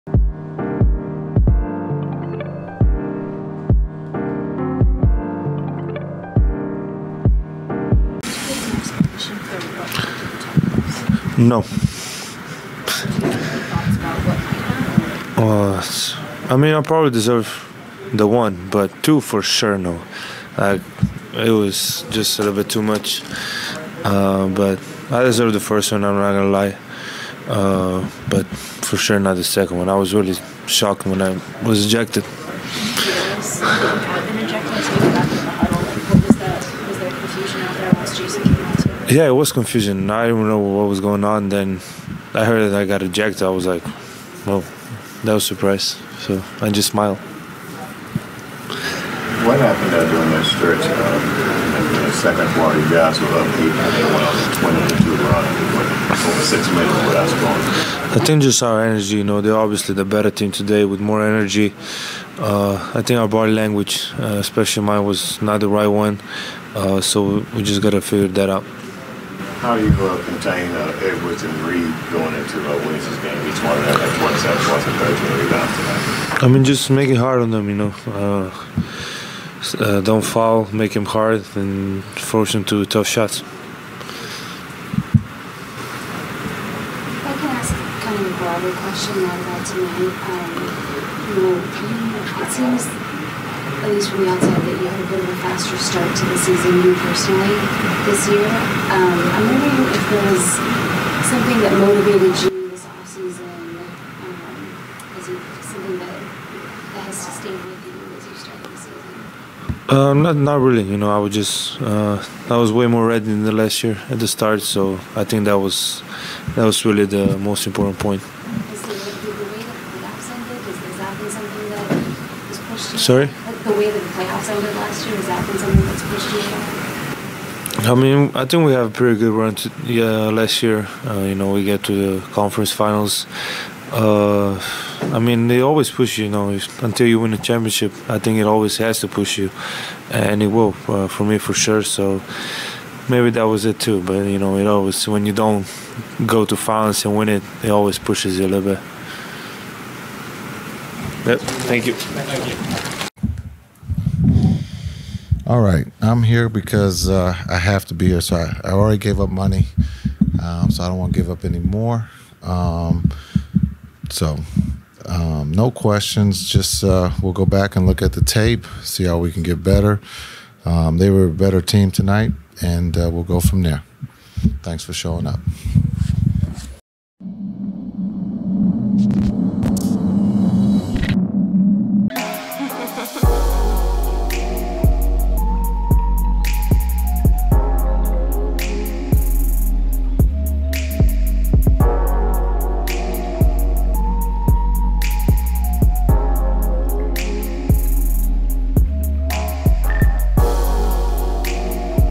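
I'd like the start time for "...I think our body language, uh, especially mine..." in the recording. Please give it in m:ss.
1:02.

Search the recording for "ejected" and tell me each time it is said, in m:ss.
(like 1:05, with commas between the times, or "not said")
0:31, 0:43.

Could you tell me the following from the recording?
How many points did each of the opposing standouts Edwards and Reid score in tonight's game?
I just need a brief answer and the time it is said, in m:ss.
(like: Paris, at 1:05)
27, at 1:14.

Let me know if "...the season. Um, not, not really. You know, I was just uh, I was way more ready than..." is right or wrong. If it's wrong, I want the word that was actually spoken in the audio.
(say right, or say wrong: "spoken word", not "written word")
right.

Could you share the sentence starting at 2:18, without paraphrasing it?
I think it always has to push you, and it will uh, for me for sure.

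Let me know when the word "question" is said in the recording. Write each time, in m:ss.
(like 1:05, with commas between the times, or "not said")
1:28, 2:45.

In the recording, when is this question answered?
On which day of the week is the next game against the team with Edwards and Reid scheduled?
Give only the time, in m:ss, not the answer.
1:12.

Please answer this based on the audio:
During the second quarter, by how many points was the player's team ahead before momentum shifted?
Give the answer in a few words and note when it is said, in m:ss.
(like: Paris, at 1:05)
8, at 0:53.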